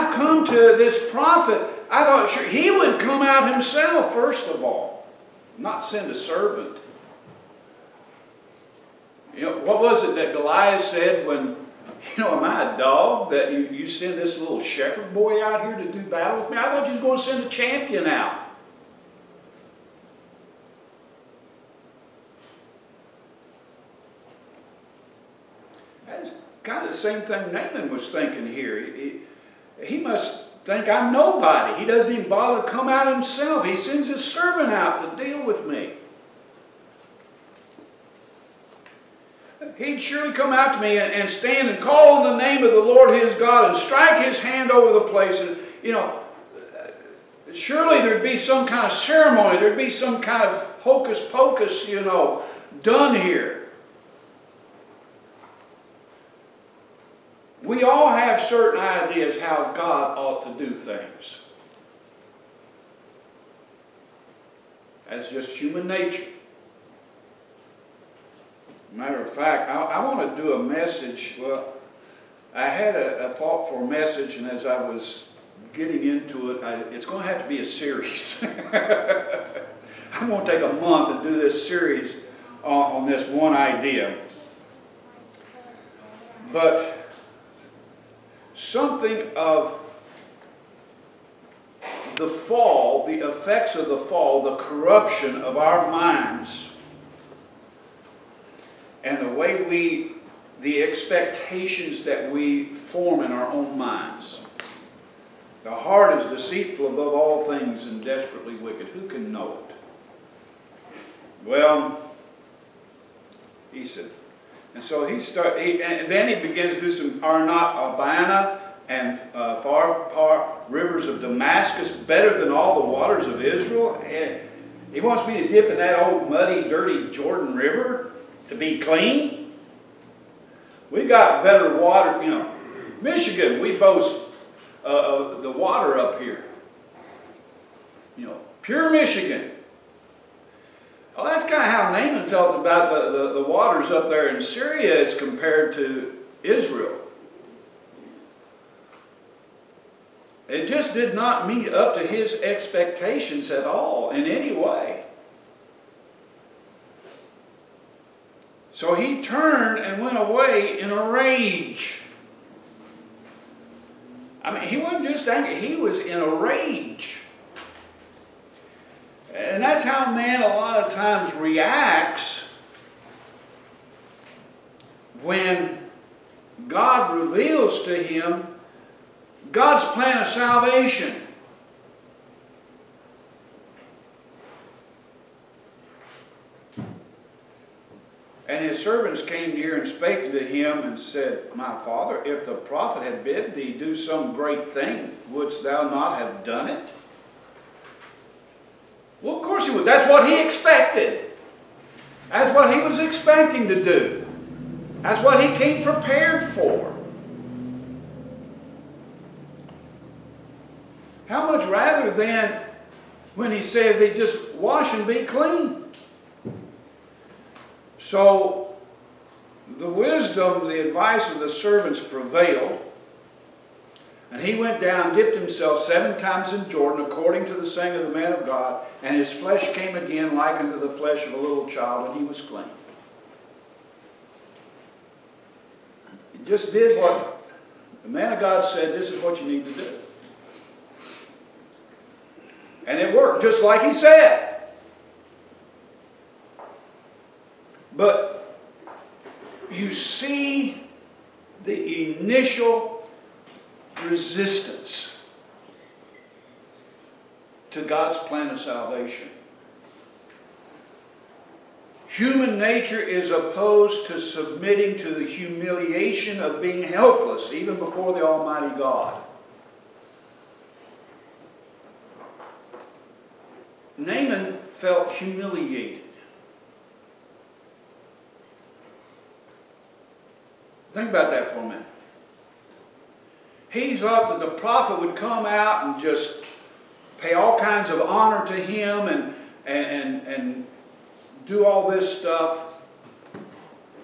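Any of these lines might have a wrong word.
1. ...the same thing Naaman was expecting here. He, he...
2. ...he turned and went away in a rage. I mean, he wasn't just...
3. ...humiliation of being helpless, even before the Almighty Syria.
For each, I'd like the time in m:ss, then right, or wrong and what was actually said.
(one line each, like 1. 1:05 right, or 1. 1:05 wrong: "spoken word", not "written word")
1. 0:26 wrong: "thinking", not "expecting"
2. 2:38 right
3. 4:25 wrong: "God", not "Syria".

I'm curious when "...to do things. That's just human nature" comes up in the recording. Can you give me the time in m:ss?
1:00.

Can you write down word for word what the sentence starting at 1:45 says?
The heart is deceitful above all things and desperately wicked.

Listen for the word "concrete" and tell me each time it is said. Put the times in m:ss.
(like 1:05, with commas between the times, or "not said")
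not said.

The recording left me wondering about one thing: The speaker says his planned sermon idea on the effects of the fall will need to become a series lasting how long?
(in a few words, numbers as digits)
A month.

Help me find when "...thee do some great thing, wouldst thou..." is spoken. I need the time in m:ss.
3:13.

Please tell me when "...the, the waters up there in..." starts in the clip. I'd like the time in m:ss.
2:23.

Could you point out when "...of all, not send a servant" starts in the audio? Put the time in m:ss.
0:04.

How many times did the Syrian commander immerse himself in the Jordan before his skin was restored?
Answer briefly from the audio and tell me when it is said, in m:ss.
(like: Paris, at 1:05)
7, at 3:45.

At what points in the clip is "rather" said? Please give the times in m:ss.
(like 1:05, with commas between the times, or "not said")
3:31.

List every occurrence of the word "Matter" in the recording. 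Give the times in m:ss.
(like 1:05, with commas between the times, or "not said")
1:08.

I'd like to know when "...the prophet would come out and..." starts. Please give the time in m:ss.
4:44.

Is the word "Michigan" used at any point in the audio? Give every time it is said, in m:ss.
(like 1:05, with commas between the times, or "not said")
2:13, 2:18.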